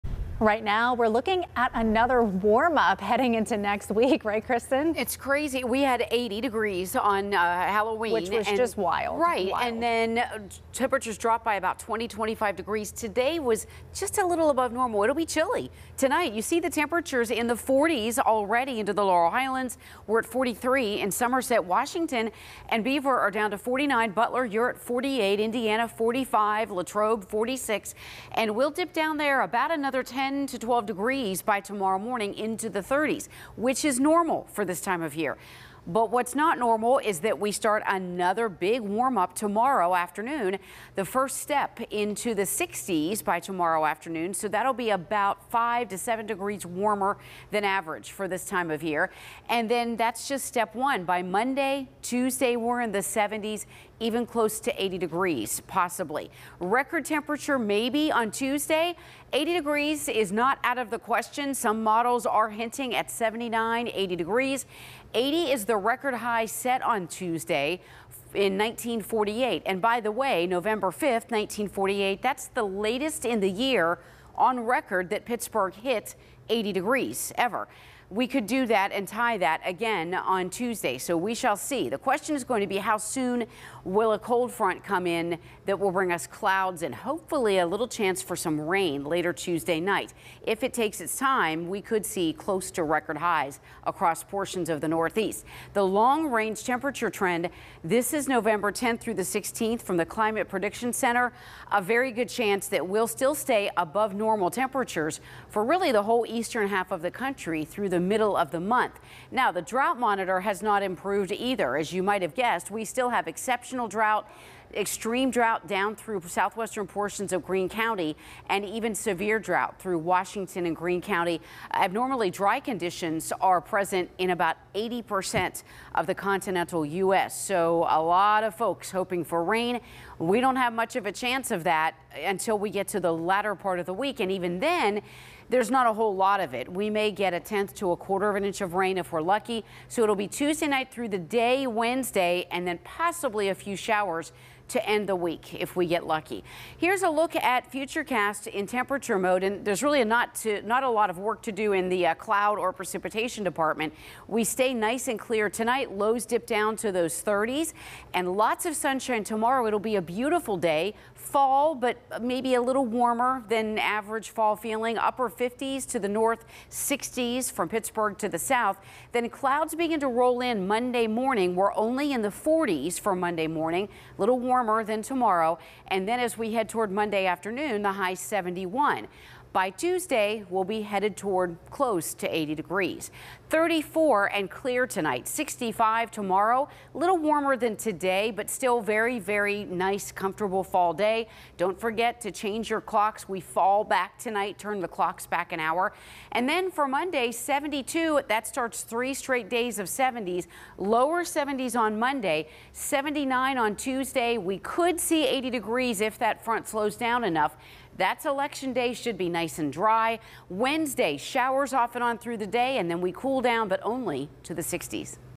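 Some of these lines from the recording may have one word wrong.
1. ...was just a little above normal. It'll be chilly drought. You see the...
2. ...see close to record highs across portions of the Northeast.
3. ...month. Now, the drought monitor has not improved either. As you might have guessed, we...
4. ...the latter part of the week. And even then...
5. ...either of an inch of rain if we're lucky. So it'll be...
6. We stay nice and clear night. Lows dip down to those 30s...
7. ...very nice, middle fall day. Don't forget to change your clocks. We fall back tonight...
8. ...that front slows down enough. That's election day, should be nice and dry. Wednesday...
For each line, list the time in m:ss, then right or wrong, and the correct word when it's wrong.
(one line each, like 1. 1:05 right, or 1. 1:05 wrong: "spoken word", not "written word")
1. 0:13 wrong: "tonight", not "drought"
2. 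1:32 right
3. 1:48 right
4. 2:12 right
5. 2:17 wrong: "quarter", not "either"
6. 2:34 wrong: "tonight", not "night"
7. 3:09 wrong: "comfortable", not "middle"
8. 3:26 right.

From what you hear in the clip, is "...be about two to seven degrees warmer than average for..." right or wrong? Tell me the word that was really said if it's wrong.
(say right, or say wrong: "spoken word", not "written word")
wrong: "five", not "two".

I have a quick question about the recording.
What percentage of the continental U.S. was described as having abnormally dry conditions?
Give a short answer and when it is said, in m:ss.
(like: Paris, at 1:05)
80 percent, at 2:04.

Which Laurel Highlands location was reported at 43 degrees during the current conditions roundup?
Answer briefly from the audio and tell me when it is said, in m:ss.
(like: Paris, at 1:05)
Somerset, at 0:21.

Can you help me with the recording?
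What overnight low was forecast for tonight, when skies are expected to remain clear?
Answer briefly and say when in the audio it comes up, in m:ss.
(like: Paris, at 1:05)
34, at 3:03.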